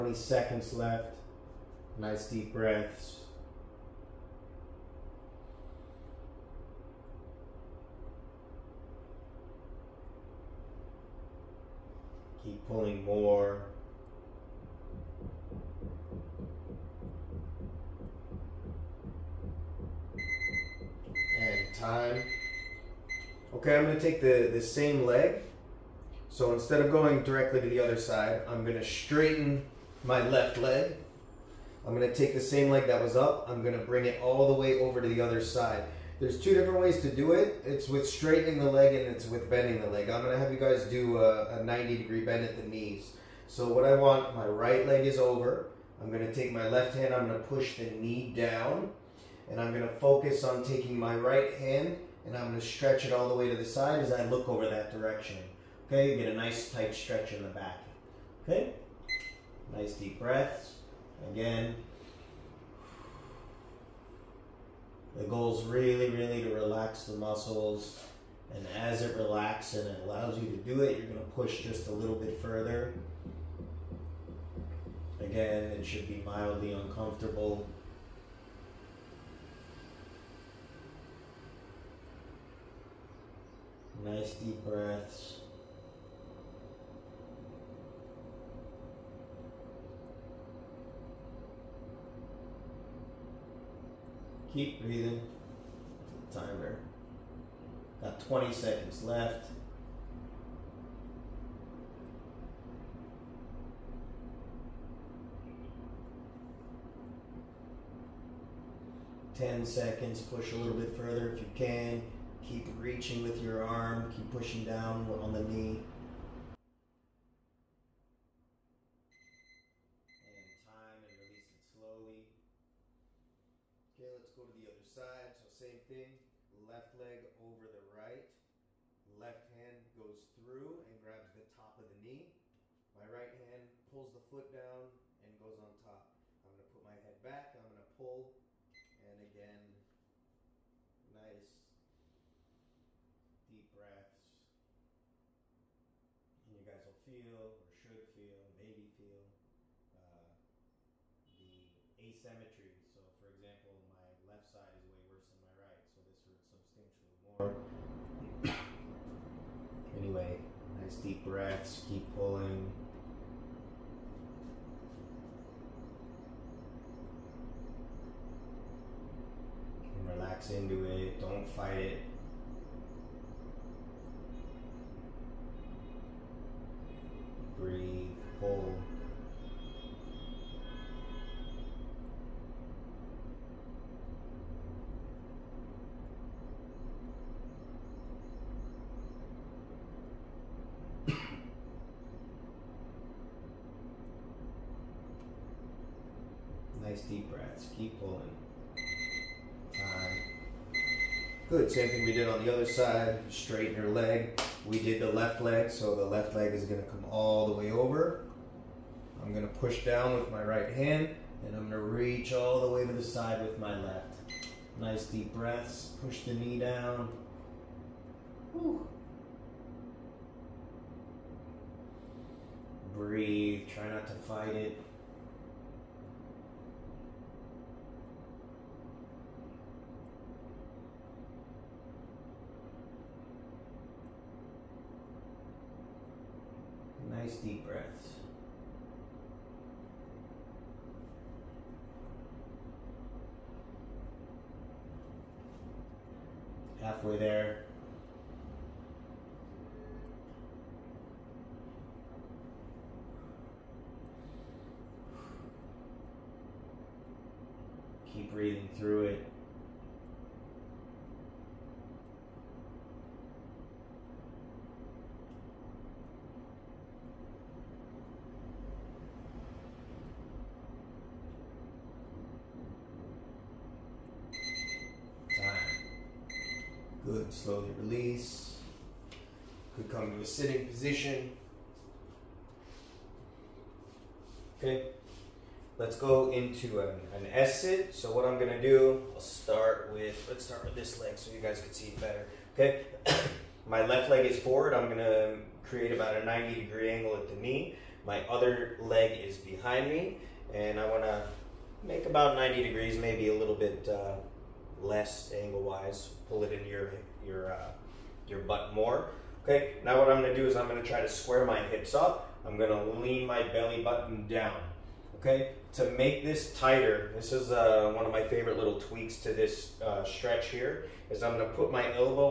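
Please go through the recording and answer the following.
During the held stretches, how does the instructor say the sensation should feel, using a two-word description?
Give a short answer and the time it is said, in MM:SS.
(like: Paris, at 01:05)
Mildly uncomfortable, at 01:16.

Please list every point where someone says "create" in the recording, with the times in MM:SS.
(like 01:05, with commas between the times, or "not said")
04:55.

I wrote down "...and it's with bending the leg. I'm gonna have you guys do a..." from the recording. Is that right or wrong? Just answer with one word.
right.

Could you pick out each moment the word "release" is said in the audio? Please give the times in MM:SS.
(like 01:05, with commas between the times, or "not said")
02:01, 04:37.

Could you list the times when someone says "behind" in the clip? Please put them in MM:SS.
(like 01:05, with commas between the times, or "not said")
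04:59.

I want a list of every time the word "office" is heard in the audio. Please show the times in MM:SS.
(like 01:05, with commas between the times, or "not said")
not said.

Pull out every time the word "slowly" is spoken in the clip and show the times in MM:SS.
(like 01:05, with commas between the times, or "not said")
02:01, 04:37.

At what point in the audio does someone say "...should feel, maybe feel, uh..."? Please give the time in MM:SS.
02:27.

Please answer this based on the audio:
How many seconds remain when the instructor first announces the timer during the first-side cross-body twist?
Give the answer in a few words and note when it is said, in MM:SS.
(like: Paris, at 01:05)
20, at 01:38.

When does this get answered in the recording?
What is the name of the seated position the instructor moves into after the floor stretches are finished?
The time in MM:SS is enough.
04:47.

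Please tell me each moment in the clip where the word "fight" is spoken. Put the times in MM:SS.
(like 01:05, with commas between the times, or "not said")
02:51, 03:44.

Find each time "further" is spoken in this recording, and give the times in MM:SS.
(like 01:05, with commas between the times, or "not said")
01:12, 01:50.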